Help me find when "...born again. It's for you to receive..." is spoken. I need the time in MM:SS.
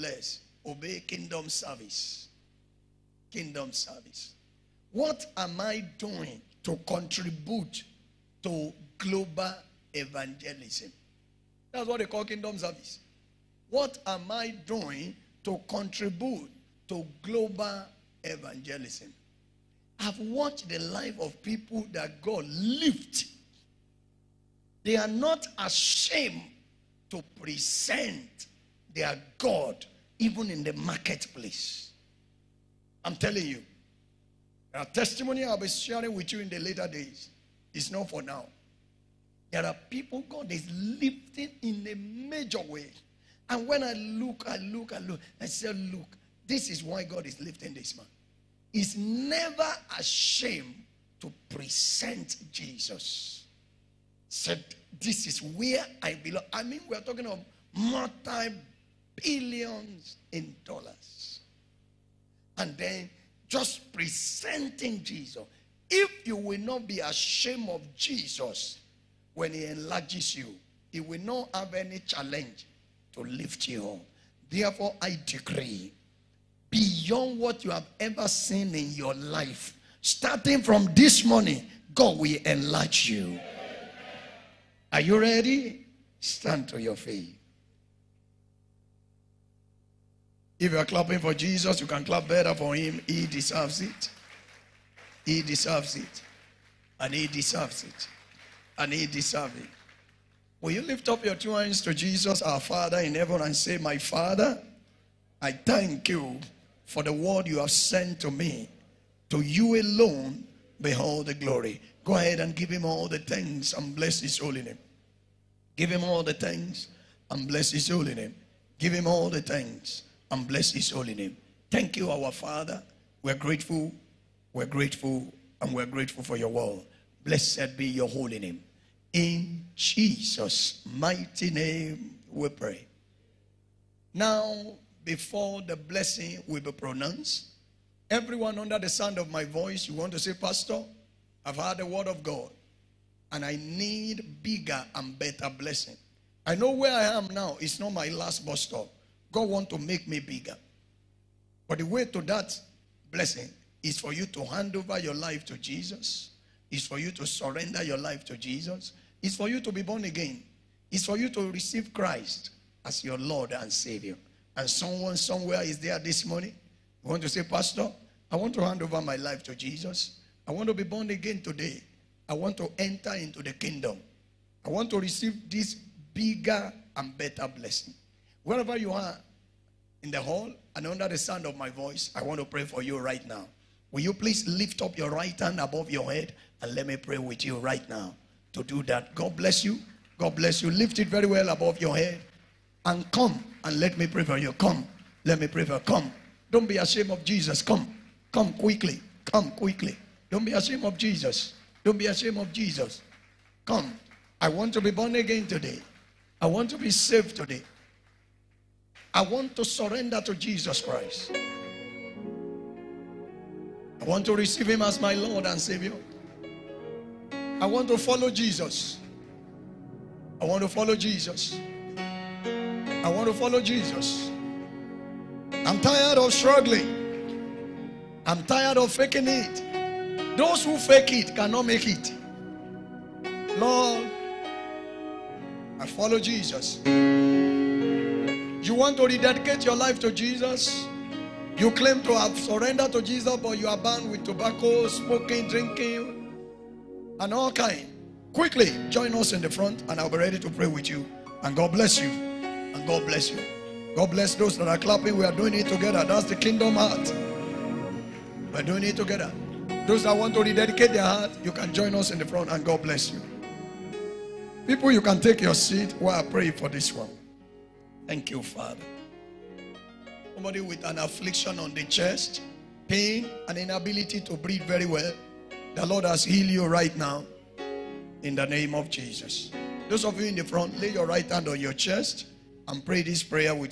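02:39.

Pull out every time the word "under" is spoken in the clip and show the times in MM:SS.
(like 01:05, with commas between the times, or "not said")
02:18, 03:00.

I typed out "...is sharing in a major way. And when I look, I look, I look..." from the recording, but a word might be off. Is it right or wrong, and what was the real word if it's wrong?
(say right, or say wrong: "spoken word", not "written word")
wrong: "lifting", not "sharing".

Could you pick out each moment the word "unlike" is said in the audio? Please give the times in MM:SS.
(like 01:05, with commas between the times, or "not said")
not said.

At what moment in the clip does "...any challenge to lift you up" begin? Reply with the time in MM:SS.
01:11.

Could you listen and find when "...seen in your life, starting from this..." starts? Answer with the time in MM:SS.
01:18.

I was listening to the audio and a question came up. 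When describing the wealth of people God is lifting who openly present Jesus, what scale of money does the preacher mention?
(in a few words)
Multi billions in dollars.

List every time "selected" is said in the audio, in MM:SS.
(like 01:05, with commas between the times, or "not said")
not said.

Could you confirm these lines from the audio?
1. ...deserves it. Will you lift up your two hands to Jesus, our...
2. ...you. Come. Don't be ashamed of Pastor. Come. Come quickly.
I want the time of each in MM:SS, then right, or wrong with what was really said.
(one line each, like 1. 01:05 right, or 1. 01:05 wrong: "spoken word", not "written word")
1. 01:39 right
2. 03:15 wrong: "Jesus", not "Pastor".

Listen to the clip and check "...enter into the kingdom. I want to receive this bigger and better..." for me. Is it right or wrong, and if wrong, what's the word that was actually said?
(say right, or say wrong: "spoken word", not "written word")
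right.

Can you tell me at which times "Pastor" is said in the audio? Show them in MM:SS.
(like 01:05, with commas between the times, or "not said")
02:20, 02:47.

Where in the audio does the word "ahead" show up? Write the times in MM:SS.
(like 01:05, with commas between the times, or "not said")
01:52.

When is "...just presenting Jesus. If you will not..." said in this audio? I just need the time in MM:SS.
01:03.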